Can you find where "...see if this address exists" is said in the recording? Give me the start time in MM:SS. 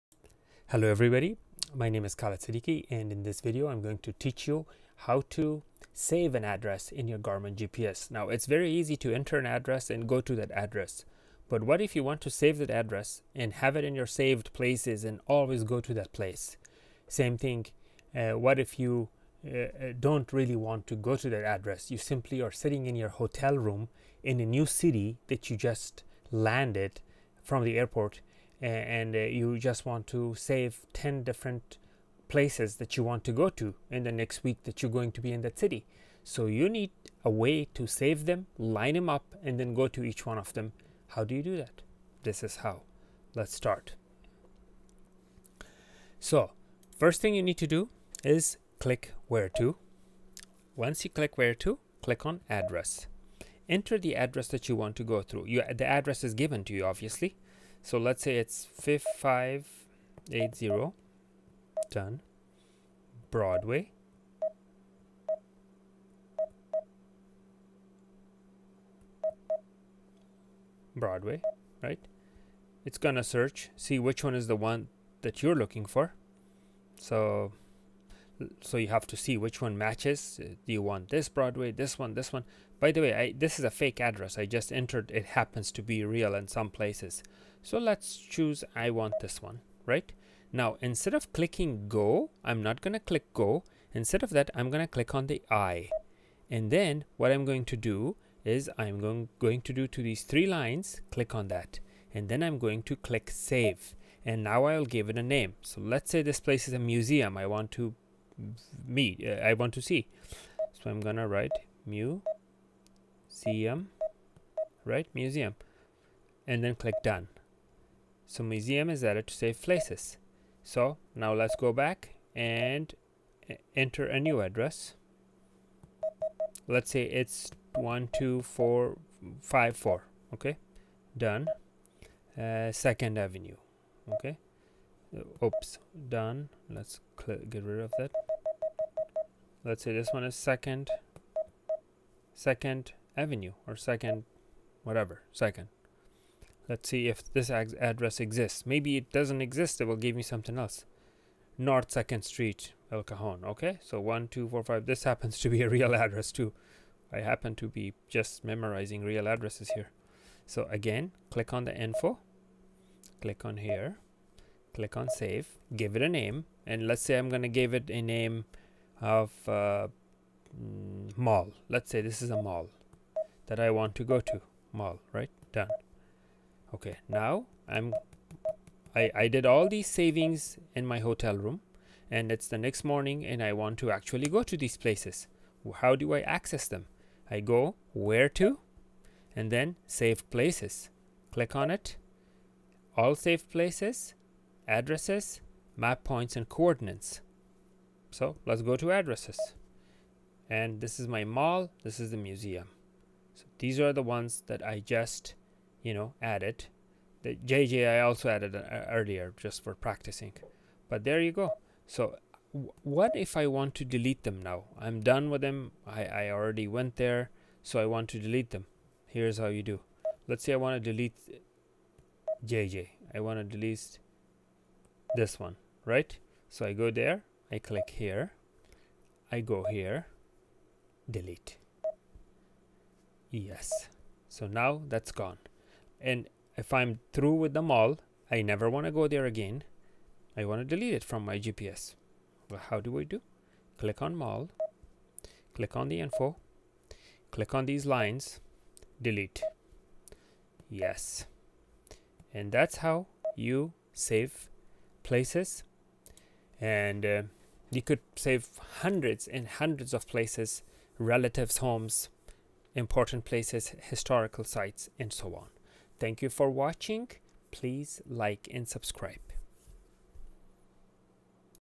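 02:26.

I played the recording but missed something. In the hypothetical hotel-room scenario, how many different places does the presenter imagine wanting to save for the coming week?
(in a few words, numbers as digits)
10.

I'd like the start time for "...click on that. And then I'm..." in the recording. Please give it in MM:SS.
01:41.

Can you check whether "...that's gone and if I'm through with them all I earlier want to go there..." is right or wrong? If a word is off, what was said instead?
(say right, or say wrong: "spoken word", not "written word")
wrong: "never", not "earlier".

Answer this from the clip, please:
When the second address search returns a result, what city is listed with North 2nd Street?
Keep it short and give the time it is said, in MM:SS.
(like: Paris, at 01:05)
El Cajon, at 02:32.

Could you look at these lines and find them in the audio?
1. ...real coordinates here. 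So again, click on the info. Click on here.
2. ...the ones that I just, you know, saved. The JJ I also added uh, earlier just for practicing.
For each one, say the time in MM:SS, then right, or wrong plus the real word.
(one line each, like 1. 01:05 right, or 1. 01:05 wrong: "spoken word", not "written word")
1. 02:39 wrong: "addresses", not "coordinates"
2. 03:23 wrong: "added", not "saved".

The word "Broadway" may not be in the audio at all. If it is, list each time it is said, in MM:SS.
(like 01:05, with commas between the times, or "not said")
01:03, 01:10, 01:21.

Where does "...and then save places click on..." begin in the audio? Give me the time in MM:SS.
03:09.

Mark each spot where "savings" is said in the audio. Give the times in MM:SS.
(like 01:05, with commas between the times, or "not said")
02:59.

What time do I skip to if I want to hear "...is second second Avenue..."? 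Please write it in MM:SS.
02:20.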